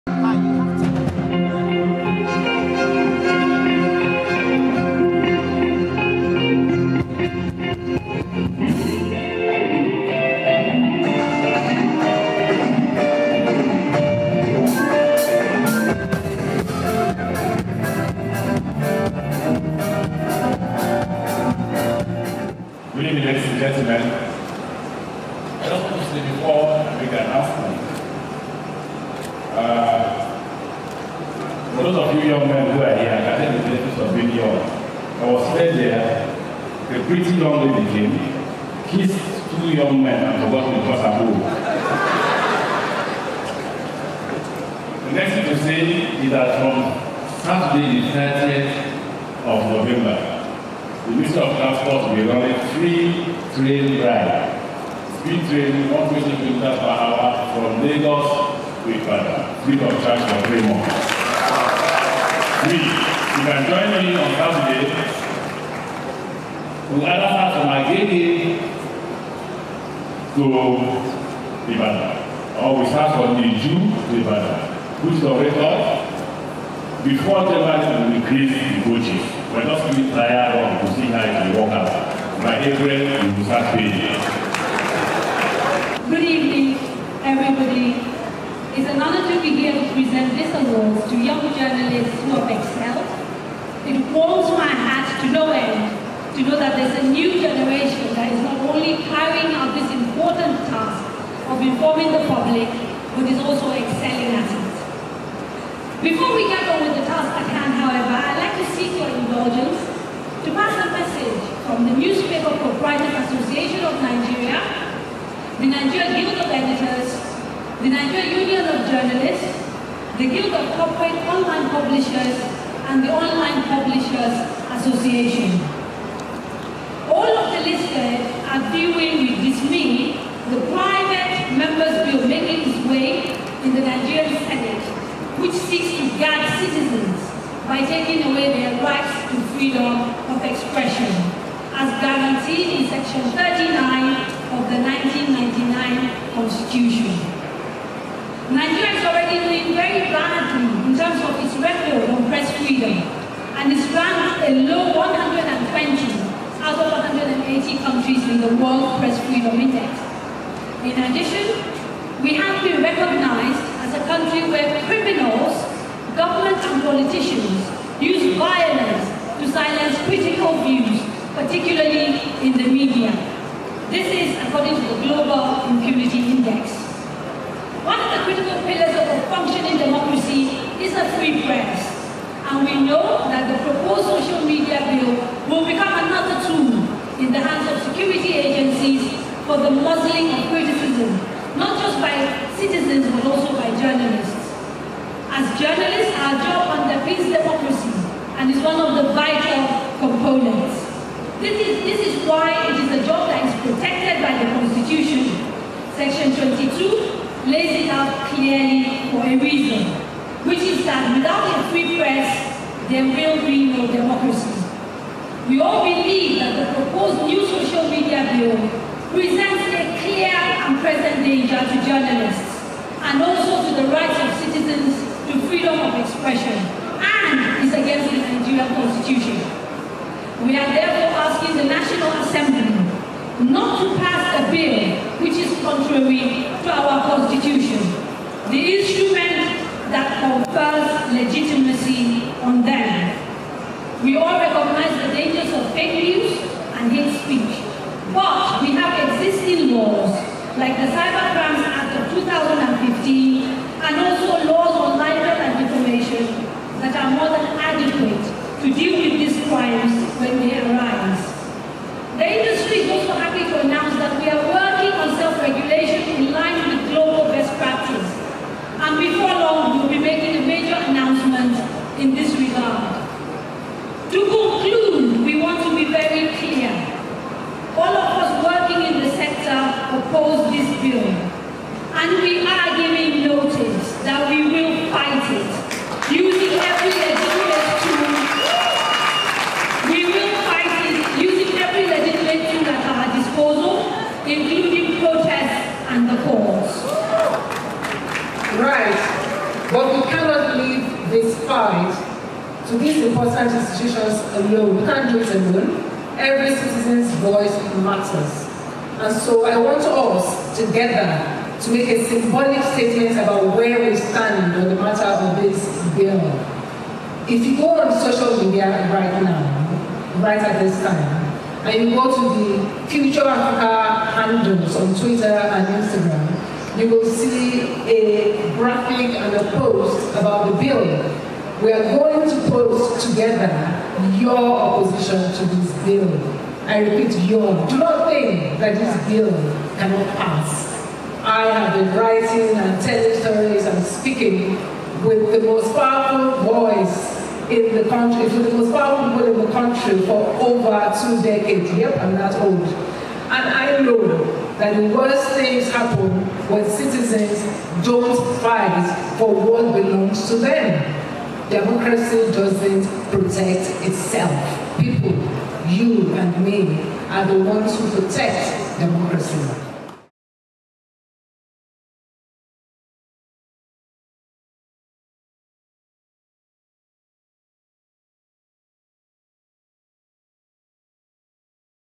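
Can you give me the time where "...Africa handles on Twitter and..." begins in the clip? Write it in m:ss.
5:23.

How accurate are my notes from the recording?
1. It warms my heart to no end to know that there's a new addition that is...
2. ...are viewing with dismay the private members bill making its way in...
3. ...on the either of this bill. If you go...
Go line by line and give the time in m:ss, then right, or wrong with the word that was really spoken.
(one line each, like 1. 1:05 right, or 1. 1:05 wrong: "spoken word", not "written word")
1. 1:33 wrong: "generation", not "addition"
2. 2:08 right
3. 5:14 wrong: "matter", not "either".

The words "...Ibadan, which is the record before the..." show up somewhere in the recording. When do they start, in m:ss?
1:14.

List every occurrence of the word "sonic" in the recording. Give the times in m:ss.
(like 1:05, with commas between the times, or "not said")
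not said.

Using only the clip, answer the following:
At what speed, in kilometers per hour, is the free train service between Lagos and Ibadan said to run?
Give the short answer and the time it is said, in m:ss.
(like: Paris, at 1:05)
120, at 0:55.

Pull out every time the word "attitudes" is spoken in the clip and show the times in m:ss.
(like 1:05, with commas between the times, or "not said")
not said.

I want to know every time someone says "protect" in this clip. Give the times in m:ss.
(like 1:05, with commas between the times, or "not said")
6:03, 6:08.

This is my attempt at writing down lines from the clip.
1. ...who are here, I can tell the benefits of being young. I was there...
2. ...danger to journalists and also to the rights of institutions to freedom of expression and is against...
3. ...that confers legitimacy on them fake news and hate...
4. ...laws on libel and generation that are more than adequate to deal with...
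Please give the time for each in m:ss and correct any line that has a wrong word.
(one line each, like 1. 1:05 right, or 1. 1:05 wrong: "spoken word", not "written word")
1. 0:32 right
2. 3:41 wrong: "citizens", not "institutions"
3. 3:59 right
4. 4:14 wrong: "defamation", not "generation".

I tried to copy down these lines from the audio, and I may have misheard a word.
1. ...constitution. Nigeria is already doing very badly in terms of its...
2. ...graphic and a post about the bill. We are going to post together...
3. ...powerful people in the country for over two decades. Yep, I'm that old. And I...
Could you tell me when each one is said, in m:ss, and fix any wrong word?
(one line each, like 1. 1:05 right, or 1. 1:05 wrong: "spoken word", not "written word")
1. 2:26 right
2. 5:28 right
3. 5:48 right.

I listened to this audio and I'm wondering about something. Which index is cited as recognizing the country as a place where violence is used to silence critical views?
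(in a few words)
Global Impunity Index.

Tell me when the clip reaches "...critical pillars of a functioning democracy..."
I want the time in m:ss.
2:58.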